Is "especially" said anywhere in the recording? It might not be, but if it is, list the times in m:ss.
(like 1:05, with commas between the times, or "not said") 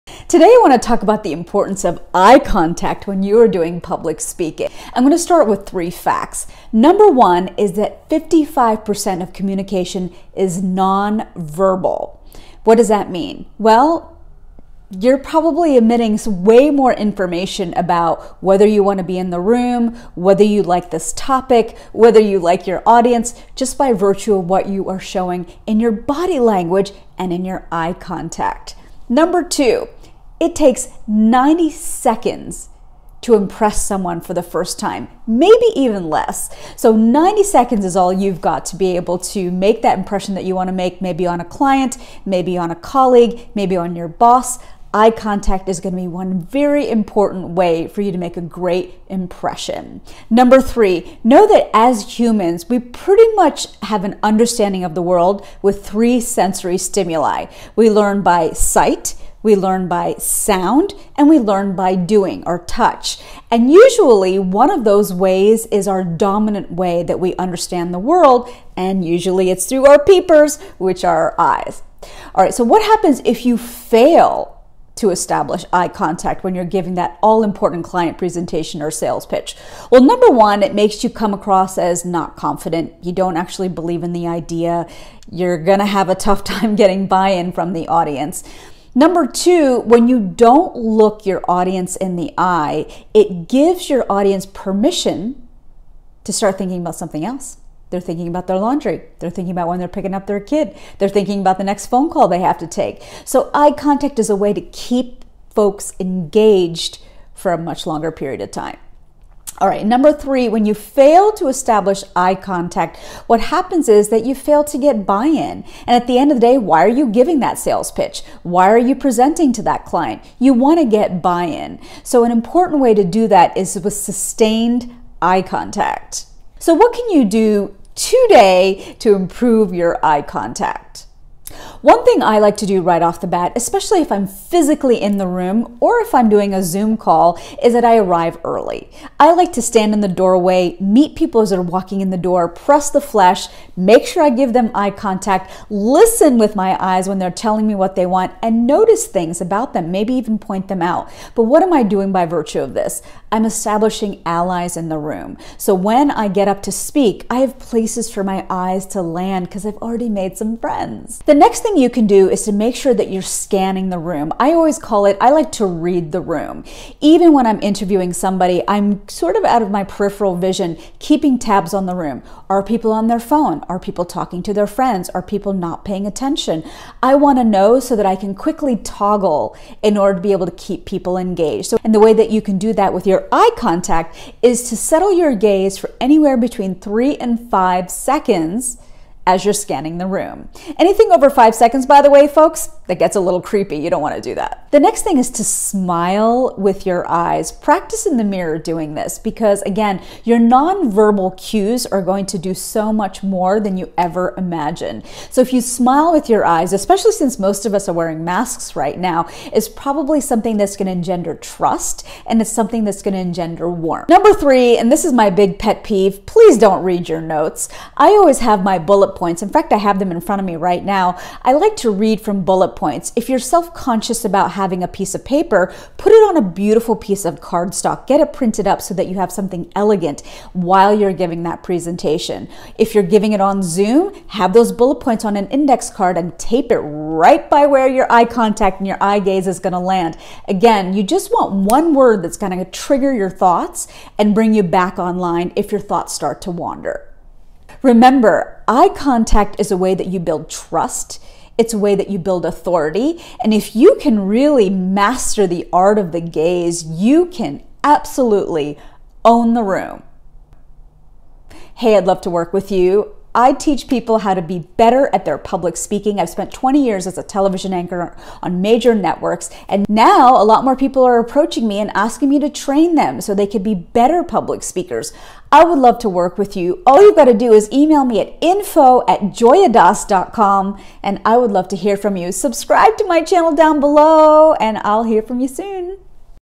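2:13, 3:26.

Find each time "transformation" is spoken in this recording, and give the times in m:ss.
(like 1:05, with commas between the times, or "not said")
not said.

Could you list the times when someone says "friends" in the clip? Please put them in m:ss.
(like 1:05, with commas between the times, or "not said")
2:40, 2:54.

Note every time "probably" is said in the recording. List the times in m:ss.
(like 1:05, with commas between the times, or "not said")
0:15, 3:29.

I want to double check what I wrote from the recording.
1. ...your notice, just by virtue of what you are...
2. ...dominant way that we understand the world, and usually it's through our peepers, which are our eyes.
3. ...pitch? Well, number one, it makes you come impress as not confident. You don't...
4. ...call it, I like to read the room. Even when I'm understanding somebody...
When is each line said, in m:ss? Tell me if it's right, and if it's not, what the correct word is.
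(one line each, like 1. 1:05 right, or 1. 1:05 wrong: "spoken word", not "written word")
1. 0:22 wrong: "audience", not "notice"
2. 1:06 right
3. 1:19 wrong: "across", not "impress"
4. 2:44 wrong: "interviewing", not "understanding".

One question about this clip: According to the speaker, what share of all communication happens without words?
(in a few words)
55%.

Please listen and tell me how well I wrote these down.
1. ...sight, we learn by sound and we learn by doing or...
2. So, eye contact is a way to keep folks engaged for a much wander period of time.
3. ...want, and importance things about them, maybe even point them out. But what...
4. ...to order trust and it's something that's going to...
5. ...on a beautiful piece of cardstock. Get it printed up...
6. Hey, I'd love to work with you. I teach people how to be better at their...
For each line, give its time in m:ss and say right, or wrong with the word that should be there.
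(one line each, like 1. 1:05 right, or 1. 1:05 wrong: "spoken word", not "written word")
1. 0:58 right
2. 1:43 wrong: "longer", not "wander"
3. 2:28 wrong: "notice", not "importance"
4. 3:30 wrong: "engender", not "order"
5. 3:46 right
6. 4:21 right.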